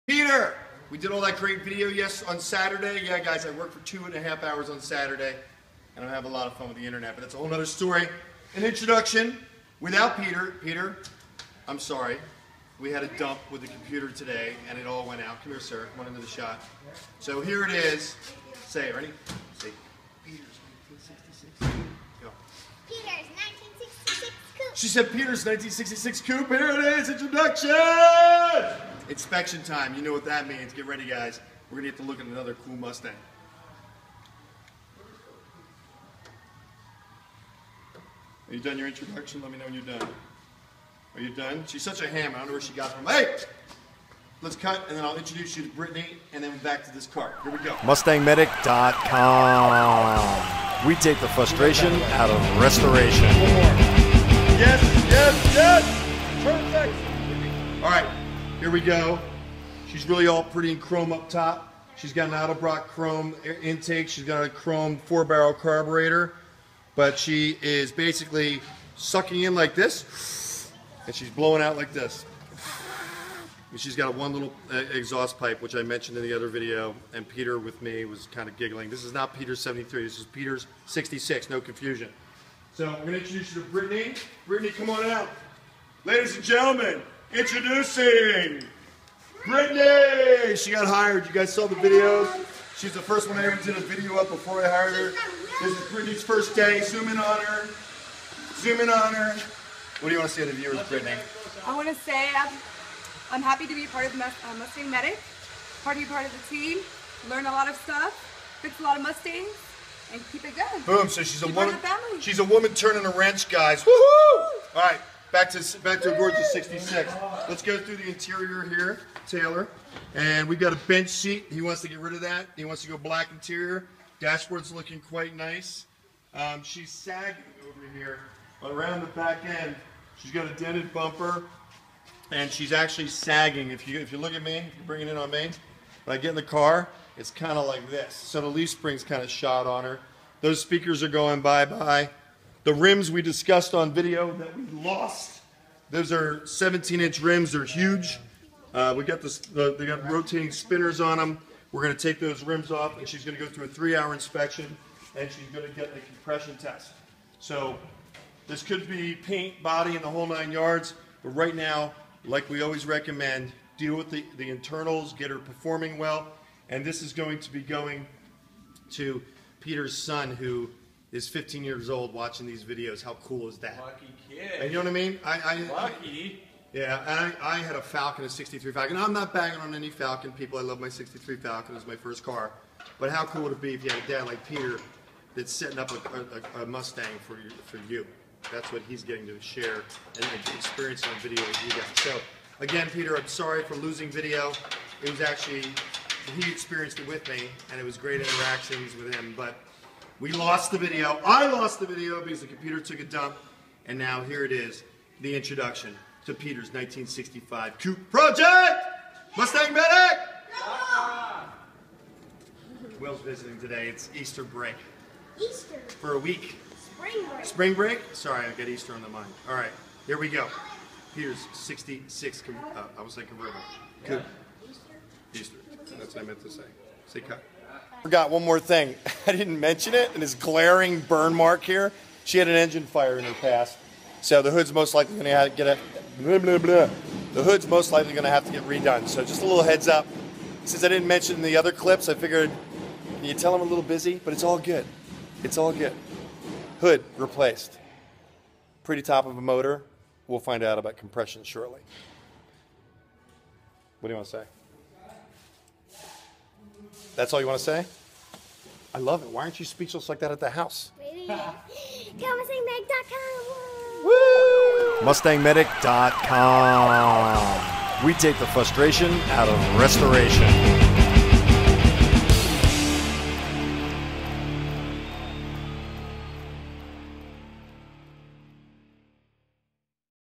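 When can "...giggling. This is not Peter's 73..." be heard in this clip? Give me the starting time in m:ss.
1:18.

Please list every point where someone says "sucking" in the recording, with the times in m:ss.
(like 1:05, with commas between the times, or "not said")
1:08.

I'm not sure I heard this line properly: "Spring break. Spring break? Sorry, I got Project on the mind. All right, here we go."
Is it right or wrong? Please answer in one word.
wrong.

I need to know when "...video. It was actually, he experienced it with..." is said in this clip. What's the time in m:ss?
3:14.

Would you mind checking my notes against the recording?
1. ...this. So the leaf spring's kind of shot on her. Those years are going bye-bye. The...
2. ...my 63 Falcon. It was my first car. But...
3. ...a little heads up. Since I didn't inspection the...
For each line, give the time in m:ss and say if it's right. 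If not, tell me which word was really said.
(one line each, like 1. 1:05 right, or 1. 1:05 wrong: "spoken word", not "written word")
1. 2:17 wrong: "speakers", not "years"
2. 3:00 right
3. 3:59 wrong: "mention", not "inspection".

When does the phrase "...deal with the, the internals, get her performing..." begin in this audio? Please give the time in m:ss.
2:43.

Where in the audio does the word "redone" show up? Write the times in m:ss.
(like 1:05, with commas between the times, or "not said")
3:58.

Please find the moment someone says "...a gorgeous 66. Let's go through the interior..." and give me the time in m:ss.
1:56.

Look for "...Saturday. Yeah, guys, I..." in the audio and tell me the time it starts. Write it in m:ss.
0:02.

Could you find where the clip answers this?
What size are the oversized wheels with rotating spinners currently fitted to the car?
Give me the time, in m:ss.
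2:26.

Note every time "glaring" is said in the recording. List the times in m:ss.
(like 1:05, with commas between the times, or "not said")
3:50.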